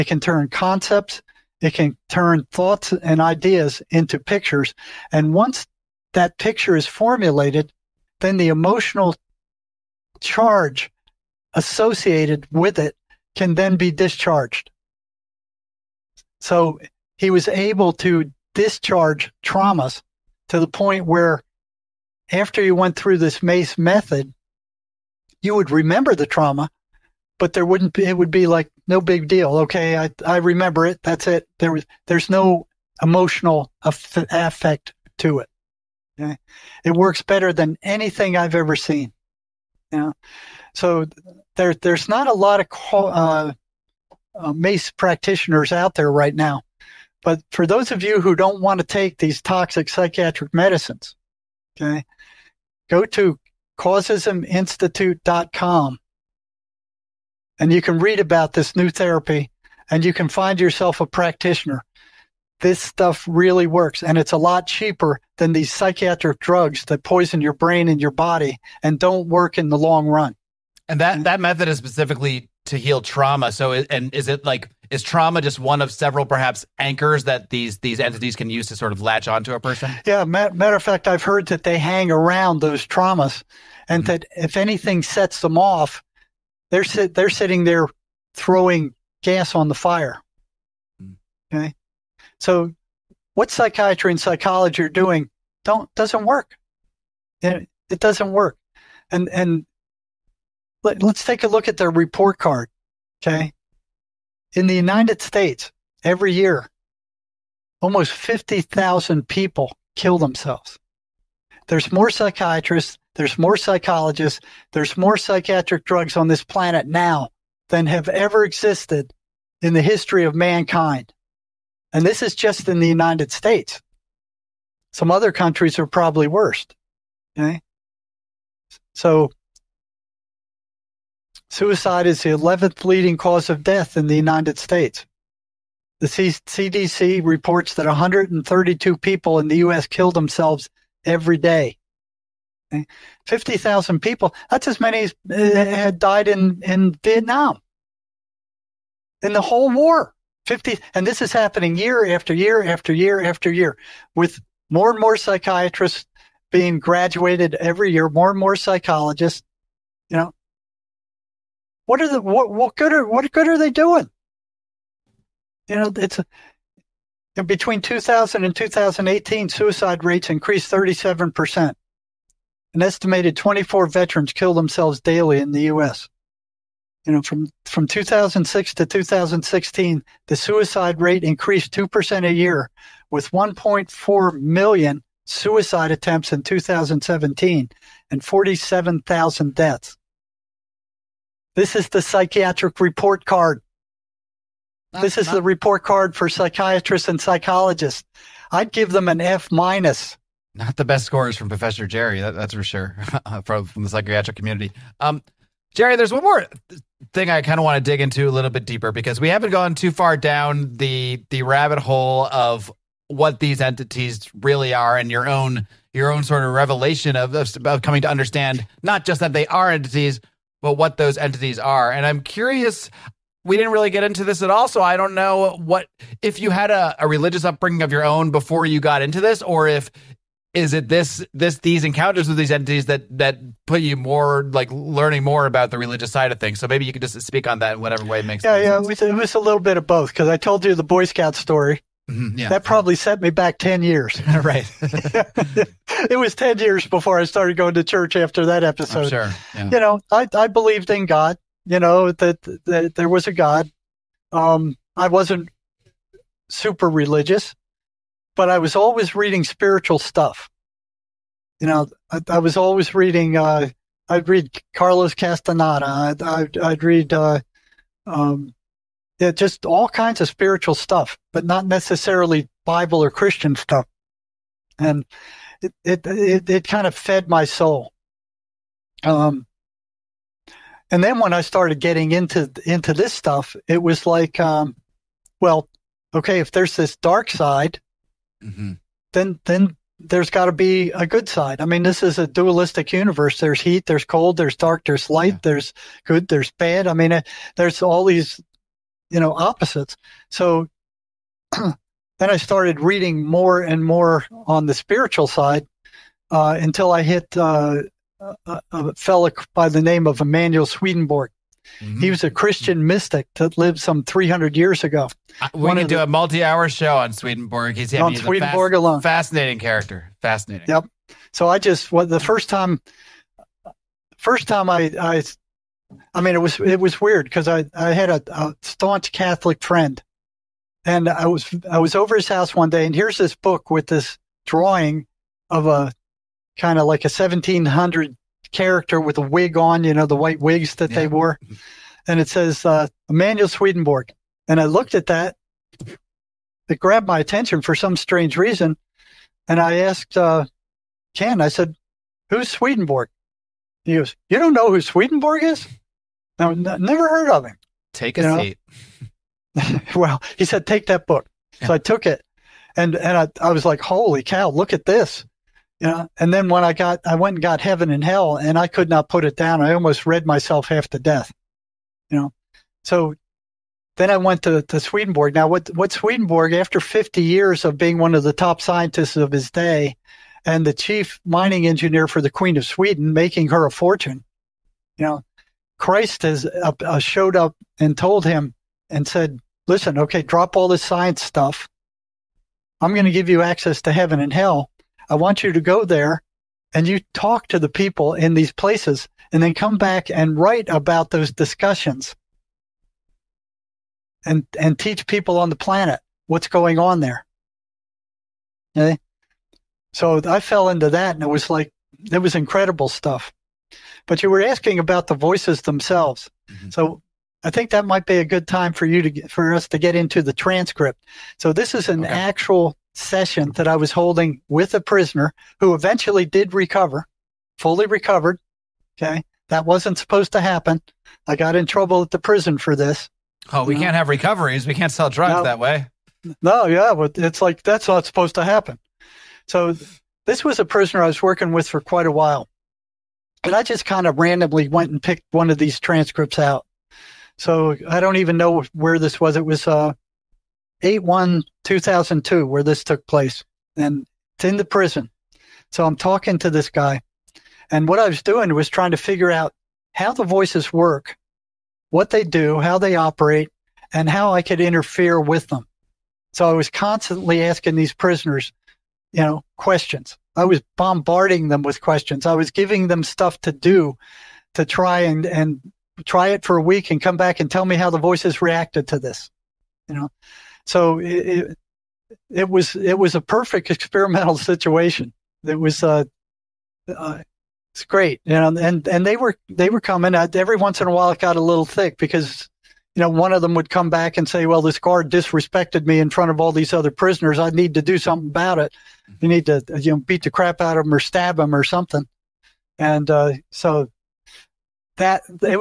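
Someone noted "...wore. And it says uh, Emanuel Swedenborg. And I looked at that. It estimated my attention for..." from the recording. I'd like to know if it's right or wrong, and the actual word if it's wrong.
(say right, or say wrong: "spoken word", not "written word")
wrong: "grabbed", not "estimated".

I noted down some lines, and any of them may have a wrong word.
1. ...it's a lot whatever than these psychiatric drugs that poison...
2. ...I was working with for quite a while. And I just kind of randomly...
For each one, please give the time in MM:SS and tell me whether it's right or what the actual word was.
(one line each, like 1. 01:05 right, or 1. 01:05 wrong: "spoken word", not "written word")
1. 01:04 wrong: "cheaper", not "whatever"
2. 07:21 right.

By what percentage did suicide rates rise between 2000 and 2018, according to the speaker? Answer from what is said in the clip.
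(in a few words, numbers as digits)
37%.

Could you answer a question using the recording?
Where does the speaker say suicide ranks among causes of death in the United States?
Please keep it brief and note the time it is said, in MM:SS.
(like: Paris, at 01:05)
11th, at 02:12.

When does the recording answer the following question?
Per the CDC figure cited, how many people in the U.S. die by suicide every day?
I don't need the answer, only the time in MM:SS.
02:17.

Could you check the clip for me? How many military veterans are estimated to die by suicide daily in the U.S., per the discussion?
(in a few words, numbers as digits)
24.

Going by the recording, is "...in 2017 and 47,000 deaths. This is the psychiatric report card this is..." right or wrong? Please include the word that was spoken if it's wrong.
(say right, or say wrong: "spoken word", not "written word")
right.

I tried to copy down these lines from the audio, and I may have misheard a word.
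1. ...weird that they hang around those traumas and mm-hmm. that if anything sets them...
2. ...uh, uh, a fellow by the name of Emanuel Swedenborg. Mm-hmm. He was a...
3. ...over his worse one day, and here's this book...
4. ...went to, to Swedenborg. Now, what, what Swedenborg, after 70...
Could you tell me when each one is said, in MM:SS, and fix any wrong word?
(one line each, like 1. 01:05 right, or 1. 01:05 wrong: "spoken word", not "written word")
1. 01:21 wrong: "heard", not "weird"
2. 05:08 right
3. 05:31 wrong: "house", not "worse"
4. 06:14 wrong: "50", not "70".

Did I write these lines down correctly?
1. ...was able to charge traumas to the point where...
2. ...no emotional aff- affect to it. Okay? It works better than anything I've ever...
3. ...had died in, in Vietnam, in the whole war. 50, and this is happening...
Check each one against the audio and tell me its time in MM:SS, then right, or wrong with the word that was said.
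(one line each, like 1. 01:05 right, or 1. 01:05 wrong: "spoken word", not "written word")
1. 00:17 wrong: "discharge", not "charge"
2. 00:32 right
3. 02:25 right.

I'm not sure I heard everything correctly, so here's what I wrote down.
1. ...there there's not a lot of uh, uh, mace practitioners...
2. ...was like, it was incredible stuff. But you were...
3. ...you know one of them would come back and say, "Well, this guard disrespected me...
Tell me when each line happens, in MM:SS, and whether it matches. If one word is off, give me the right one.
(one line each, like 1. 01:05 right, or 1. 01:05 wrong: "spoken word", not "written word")
1. 00:41 right
2. 06:51 right
3. 08:12 right.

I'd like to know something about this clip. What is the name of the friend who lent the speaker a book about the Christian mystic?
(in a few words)
Ken.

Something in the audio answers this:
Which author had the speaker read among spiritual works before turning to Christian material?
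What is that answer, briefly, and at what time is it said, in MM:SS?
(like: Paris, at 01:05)
Carlos Castaneda, at 04:24.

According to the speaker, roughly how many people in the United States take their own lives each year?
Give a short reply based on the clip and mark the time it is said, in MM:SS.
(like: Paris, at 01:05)
50,000, at 01:47.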